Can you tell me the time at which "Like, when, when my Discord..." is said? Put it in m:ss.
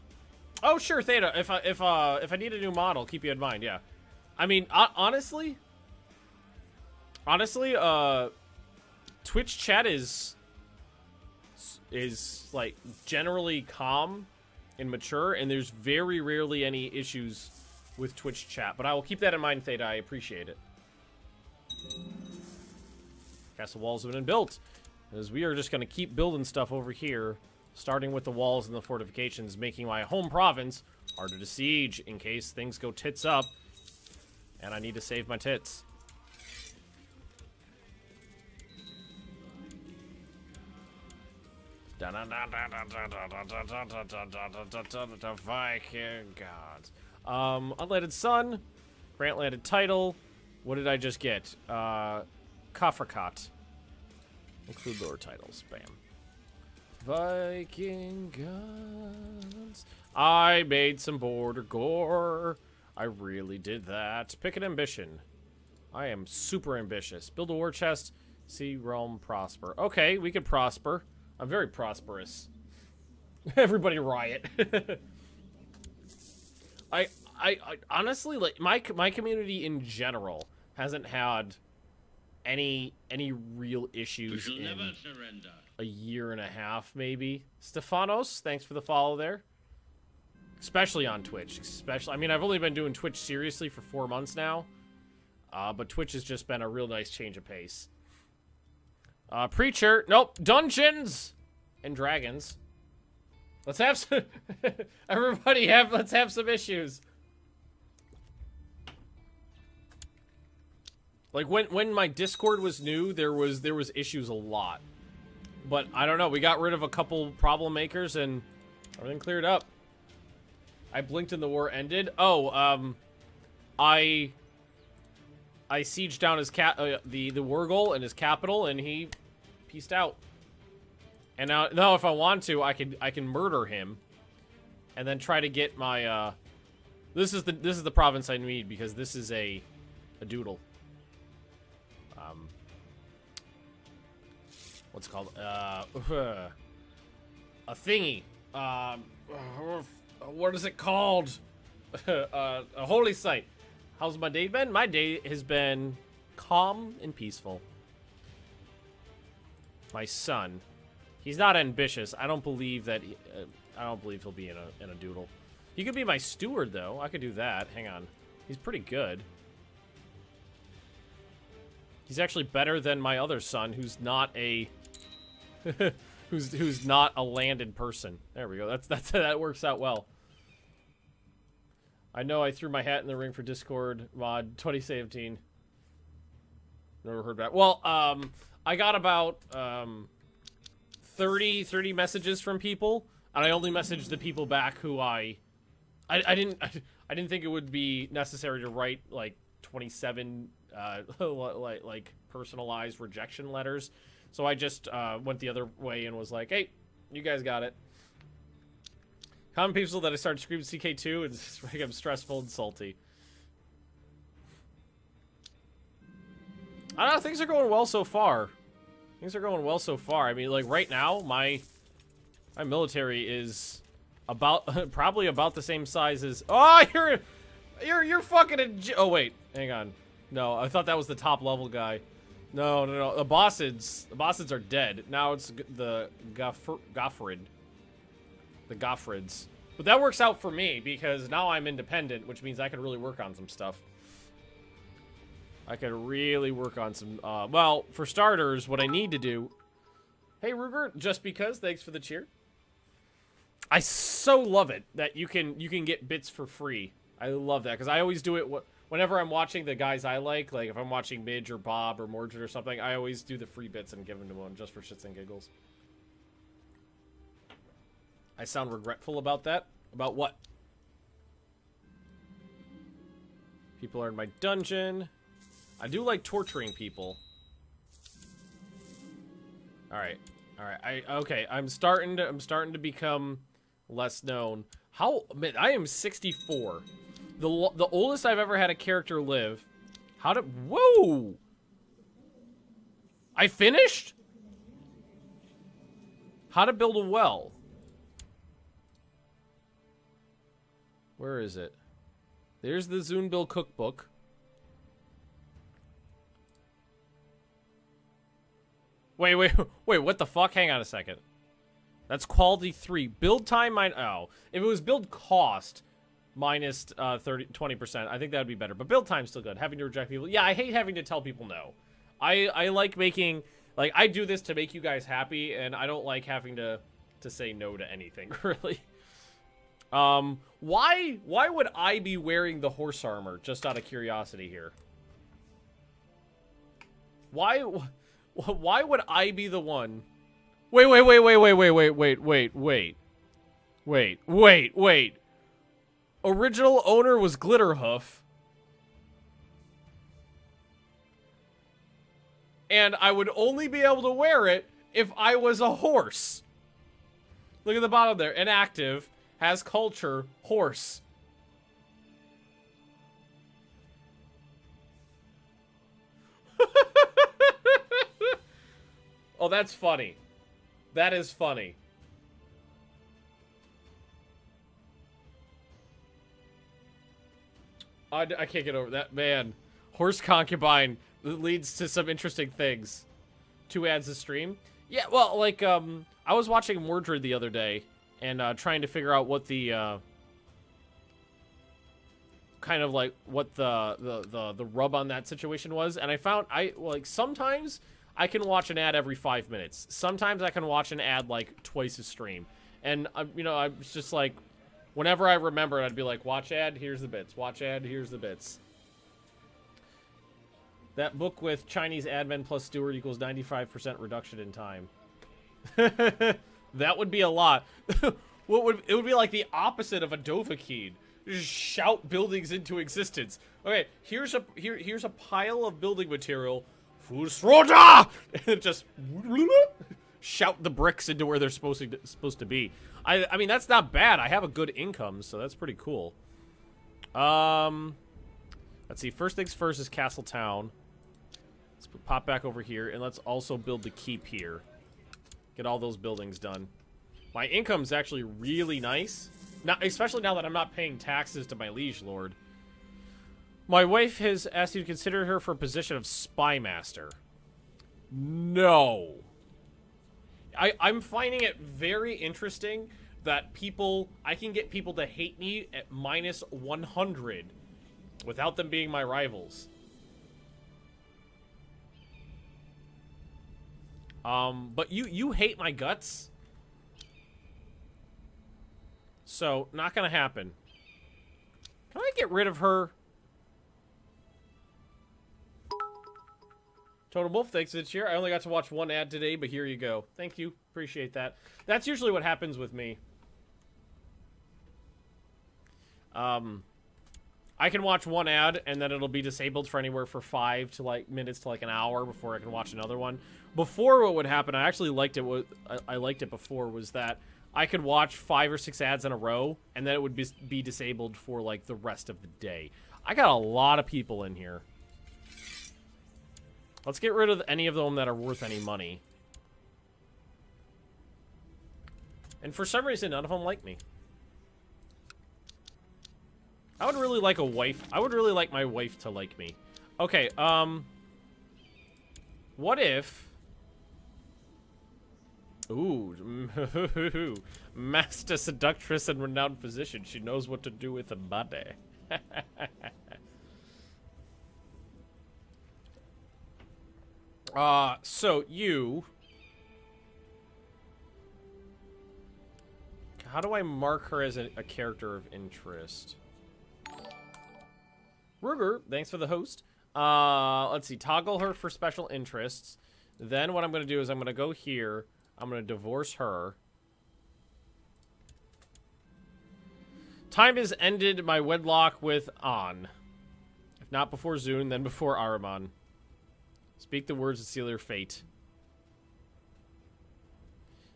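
1:51.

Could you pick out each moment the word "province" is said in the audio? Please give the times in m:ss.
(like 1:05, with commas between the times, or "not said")
0:30, 2:17.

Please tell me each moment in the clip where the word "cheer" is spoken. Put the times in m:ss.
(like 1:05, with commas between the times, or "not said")
4:11, 8:07.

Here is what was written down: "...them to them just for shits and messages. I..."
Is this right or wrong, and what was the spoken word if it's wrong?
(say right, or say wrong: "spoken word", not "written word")
wrong: "giggles", not "messages".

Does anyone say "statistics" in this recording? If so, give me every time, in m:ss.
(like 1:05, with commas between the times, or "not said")
not said.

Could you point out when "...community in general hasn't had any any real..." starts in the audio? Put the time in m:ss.
1:19.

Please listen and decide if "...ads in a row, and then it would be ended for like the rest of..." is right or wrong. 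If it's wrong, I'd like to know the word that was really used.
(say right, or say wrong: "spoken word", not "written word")
wrong: "disabled", not "ended".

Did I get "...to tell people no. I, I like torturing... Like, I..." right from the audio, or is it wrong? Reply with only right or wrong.
wrong.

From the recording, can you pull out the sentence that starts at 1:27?
Stefanos, thanks for the follow there.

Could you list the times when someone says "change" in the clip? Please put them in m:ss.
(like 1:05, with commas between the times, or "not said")
1:37.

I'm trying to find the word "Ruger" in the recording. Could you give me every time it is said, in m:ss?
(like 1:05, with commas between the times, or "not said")
4:10, 9:18.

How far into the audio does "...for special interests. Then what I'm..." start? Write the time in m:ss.
9:21.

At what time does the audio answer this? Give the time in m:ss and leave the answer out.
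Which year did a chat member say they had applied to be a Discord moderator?
3:04.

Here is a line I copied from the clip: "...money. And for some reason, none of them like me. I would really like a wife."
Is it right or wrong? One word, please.
right.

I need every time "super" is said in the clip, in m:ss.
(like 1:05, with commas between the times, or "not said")
1:06.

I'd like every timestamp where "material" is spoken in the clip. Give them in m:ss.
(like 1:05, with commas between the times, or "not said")
7:06.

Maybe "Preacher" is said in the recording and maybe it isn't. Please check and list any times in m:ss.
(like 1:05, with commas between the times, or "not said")
1:39.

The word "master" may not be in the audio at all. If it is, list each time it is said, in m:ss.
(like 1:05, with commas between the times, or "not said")
7:36, 8:57.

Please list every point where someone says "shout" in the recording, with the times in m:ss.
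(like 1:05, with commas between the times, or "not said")
7:01, 7:10.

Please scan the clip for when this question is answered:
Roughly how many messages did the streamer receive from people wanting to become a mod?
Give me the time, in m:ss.
3:11.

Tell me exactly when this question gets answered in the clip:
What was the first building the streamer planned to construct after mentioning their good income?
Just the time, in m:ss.
7:19.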